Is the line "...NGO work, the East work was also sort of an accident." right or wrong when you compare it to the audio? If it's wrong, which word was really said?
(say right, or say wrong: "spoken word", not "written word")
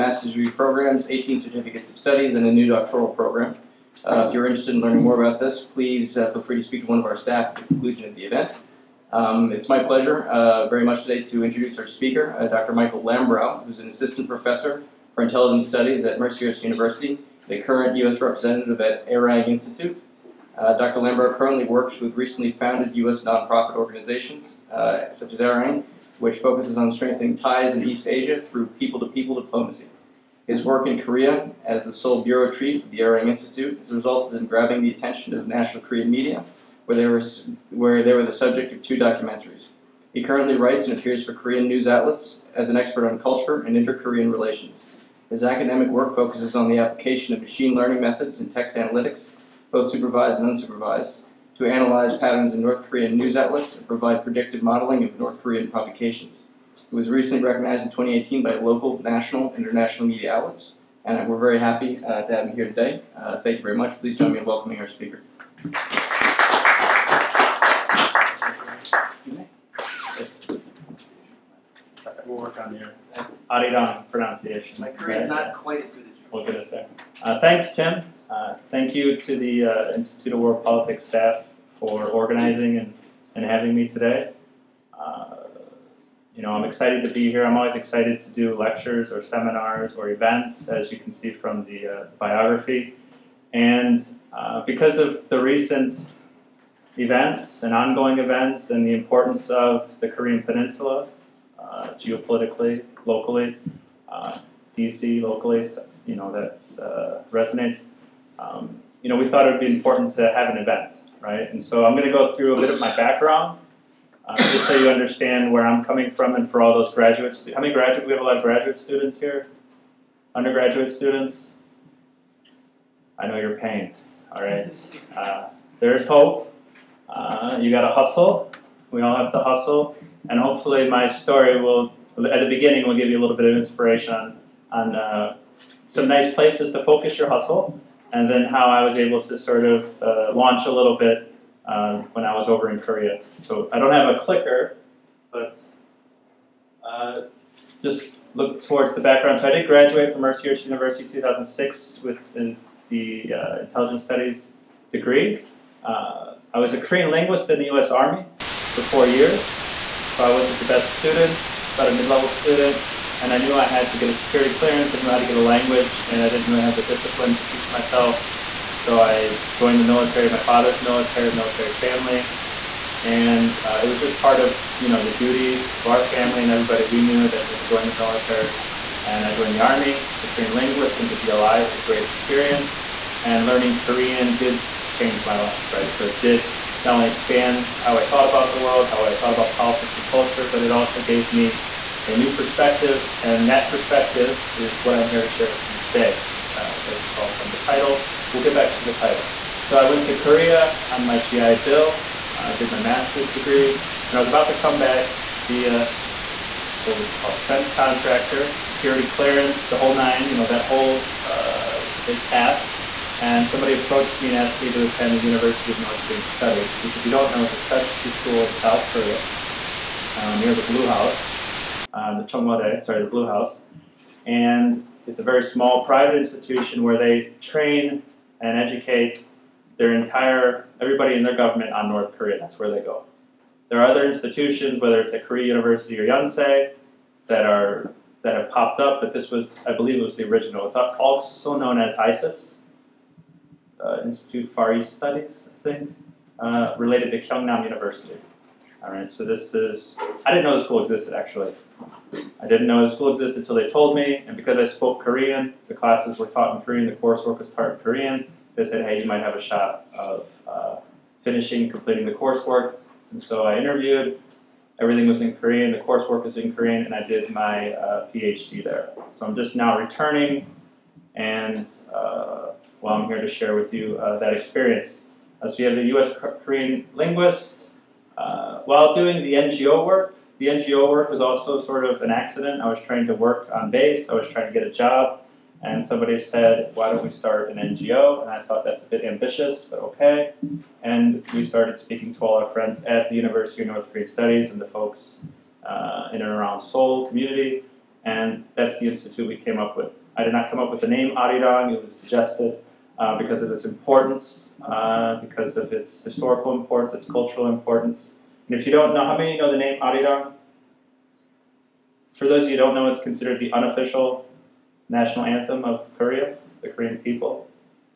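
wrong: "NGO", not "East".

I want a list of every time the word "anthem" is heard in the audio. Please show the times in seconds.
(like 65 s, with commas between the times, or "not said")
315 s.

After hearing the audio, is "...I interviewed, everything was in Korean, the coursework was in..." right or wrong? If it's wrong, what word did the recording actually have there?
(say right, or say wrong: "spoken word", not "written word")
right.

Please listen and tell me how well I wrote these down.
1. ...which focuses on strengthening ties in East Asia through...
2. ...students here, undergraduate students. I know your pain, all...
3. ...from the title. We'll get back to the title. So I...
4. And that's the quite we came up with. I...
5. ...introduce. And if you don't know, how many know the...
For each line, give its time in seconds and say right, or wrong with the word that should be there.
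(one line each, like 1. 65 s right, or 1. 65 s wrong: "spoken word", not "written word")
1. 26 s right
2. 118 s right
3. 197 s right
4. 298 s wrong: "institute", not "quite"
5. 307 s wrong: "importance", not "introduce".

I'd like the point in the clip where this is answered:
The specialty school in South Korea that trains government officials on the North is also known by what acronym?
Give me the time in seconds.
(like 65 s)
241 s.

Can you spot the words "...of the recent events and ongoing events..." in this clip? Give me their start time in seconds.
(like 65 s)
94 s.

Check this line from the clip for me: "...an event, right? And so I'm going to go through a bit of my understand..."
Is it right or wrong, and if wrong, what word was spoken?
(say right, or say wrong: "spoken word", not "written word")
wrong: "background", not "understand".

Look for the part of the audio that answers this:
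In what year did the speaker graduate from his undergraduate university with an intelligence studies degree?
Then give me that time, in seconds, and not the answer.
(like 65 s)
151 s.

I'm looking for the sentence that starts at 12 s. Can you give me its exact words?
Michael Lambrow, who's an assistant professor for intelligence studies at Mercer University the current U.S.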